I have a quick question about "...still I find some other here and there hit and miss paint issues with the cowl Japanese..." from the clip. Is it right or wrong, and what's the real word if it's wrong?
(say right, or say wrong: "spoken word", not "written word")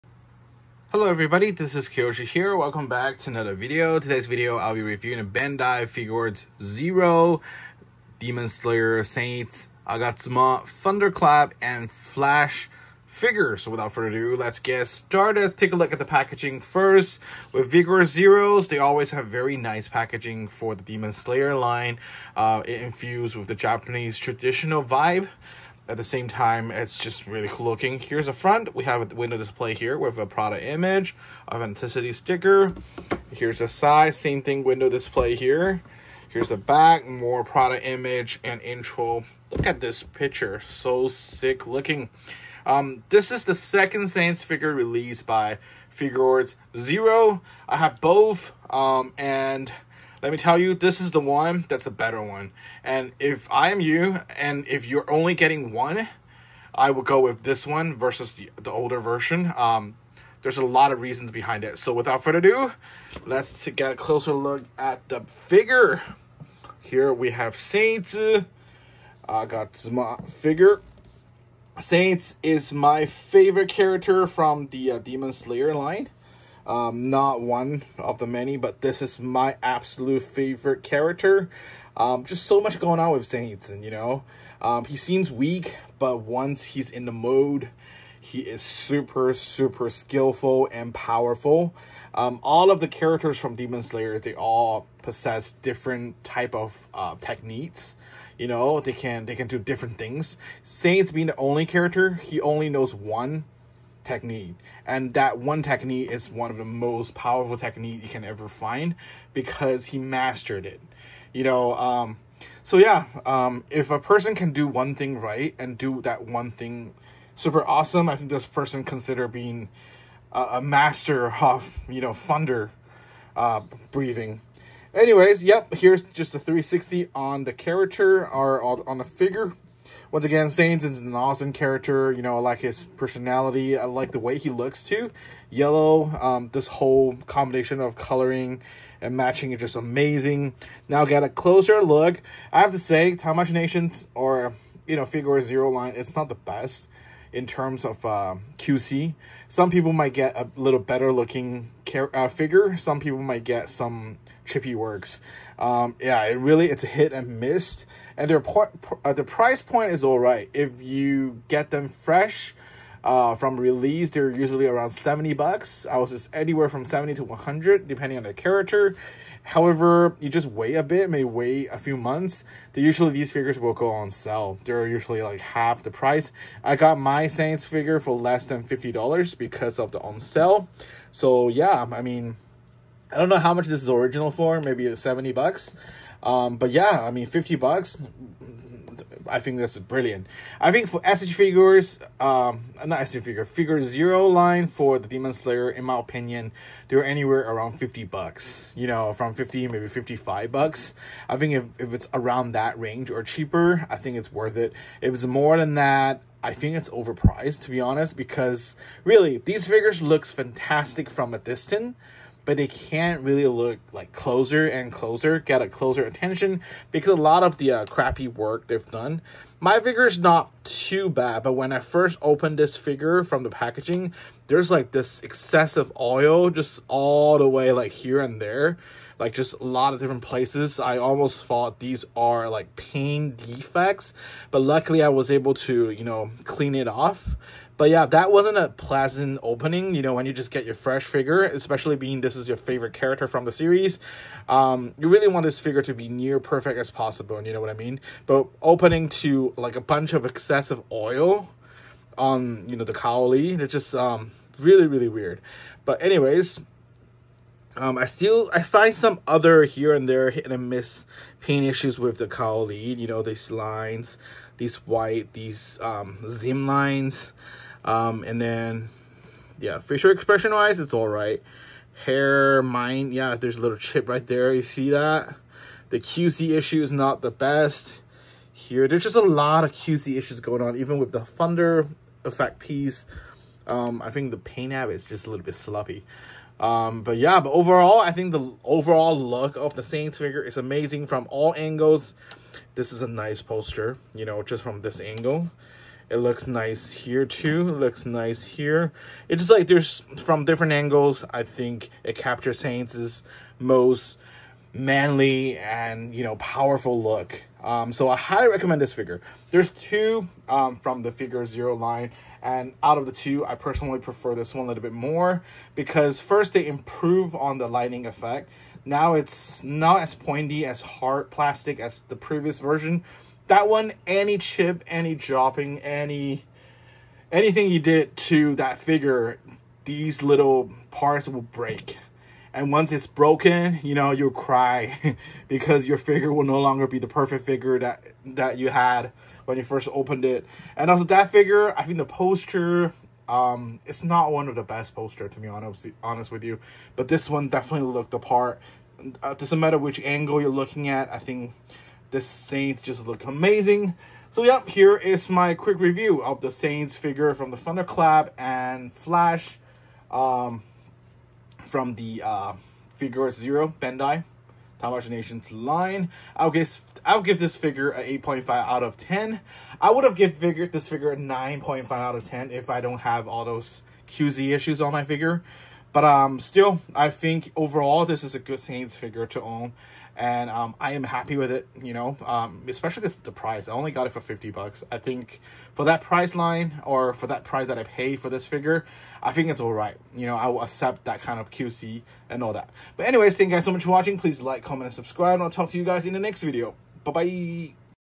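wrong: "You", not "Japanese".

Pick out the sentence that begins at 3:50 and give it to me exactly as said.
I almost thought these are like paint defects, but luckily I was able to, you know, clean it off.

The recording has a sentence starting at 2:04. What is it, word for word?
Anyways, yep, here's just a 360 on the character or on the figure.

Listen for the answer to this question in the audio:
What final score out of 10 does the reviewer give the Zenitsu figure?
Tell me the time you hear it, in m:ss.
6:08.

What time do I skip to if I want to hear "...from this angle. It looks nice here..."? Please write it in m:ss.
4:54.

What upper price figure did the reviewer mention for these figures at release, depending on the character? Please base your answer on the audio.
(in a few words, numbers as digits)
$100.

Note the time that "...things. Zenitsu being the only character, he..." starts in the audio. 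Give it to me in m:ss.
1:39.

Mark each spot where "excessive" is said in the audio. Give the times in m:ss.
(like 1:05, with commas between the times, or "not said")
3:45, 4:10.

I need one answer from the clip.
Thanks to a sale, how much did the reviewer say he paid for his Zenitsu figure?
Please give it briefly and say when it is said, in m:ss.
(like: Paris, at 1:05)
less than $50, at 2:58.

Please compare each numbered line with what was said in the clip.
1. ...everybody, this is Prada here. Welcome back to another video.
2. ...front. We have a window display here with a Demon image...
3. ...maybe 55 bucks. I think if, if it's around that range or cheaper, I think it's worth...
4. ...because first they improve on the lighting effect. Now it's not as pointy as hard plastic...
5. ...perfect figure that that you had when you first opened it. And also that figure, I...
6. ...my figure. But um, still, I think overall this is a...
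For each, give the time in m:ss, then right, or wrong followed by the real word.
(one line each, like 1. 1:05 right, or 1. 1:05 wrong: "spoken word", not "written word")
1. 0:01 wrong: "Kiyoshi", not "Prada"
2. 0:28 wrong: "Prada", not "Demon"
3. 3:19 right
4. 5:15 right
5. 5:37 right
6. 6:14 right.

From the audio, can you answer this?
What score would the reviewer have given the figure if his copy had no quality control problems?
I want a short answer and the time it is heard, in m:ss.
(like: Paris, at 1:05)
9.5 out of 10, at 6:11.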